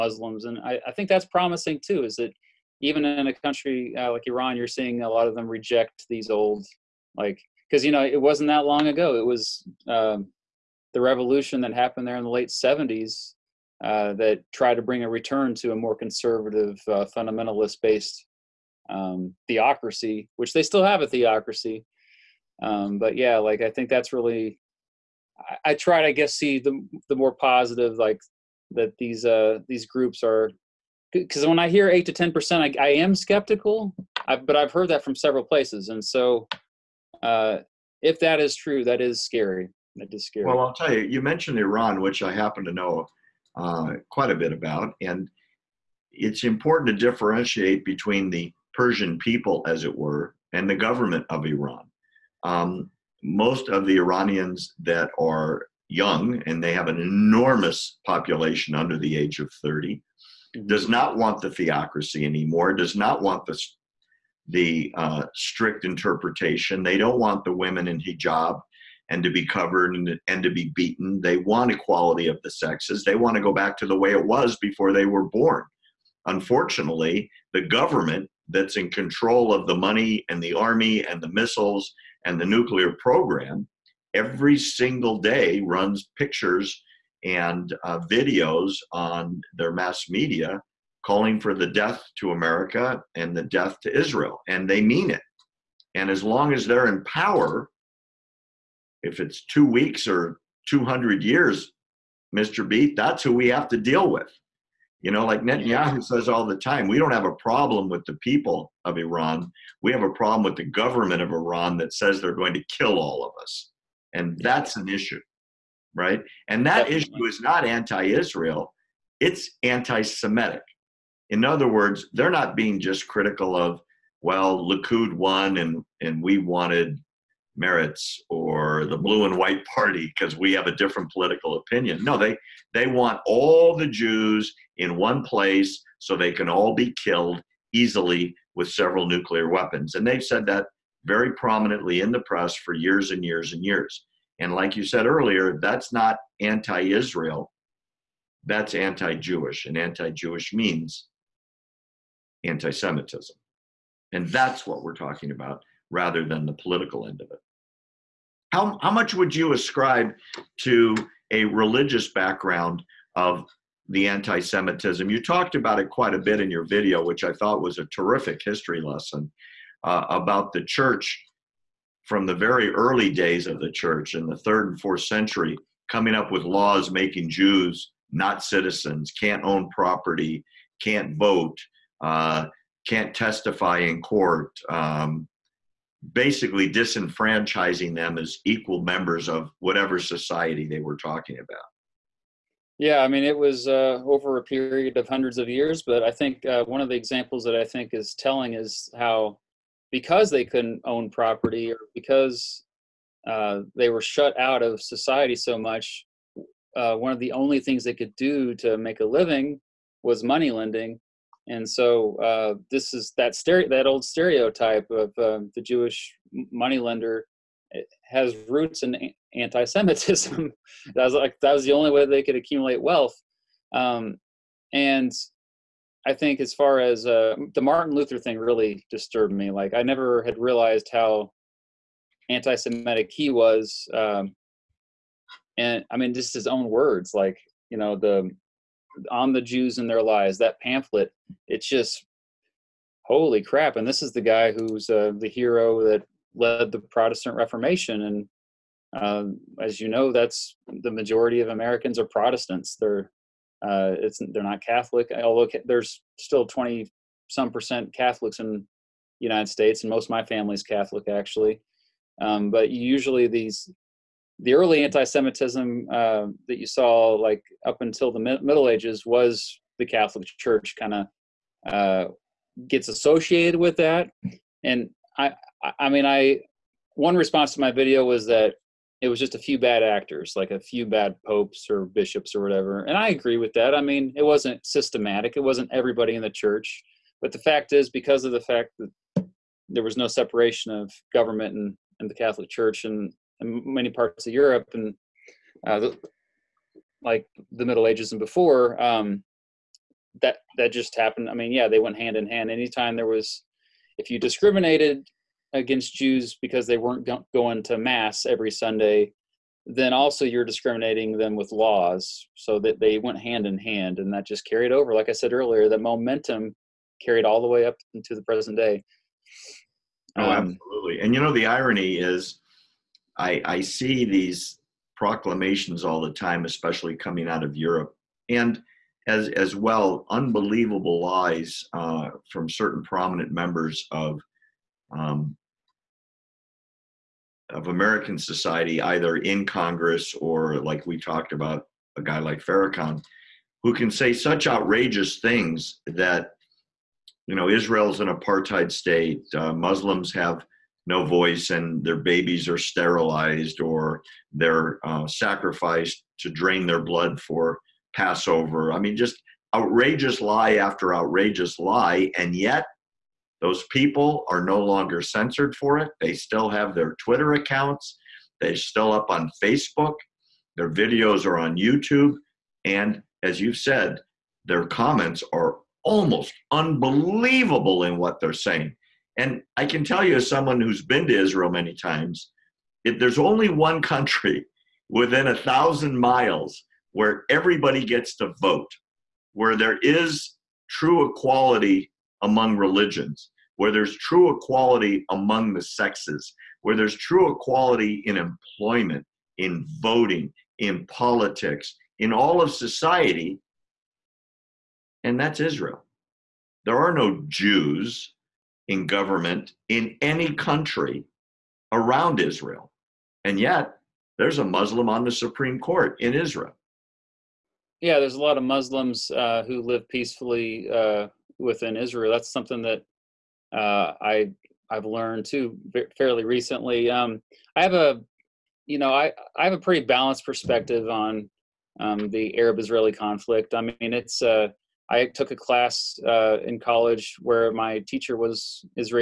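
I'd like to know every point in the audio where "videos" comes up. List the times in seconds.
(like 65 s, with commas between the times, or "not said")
88 s, 166 s, 277 s, 370 s.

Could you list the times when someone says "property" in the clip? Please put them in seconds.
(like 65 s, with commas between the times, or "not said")
179 s, 201 s.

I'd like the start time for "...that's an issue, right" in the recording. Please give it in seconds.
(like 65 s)
114 s.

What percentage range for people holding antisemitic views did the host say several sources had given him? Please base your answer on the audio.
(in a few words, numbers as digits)
8 to 10 percent.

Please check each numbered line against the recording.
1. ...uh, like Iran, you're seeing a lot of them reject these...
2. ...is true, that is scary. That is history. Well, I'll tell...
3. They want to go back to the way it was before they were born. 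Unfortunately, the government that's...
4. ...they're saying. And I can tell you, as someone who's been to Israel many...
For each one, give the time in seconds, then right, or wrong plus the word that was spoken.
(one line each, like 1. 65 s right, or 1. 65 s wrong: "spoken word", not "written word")
1. 3 s right
2. 38 s wrong: "scary", not "history"
3. 73 s right
4. 378 s right.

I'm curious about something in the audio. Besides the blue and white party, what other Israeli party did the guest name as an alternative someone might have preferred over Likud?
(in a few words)
Meretz.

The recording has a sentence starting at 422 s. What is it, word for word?
That's something that uh, I I've learned too fairly recently.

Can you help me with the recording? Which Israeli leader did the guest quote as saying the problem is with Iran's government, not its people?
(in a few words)
Netanyahu.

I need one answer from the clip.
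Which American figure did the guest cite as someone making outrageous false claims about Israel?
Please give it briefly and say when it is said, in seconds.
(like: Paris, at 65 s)
Farrakhan, at 342 s.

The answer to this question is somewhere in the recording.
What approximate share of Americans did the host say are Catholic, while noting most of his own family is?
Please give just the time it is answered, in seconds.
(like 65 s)
256 s.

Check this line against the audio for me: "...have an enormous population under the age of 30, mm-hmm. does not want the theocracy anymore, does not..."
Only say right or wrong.
right.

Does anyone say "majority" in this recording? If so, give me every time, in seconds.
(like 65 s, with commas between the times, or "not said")
250 s.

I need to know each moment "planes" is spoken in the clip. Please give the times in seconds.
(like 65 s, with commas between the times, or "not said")
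not said.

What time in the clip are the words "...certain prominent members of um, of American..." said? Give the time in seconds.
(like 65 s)
332 s.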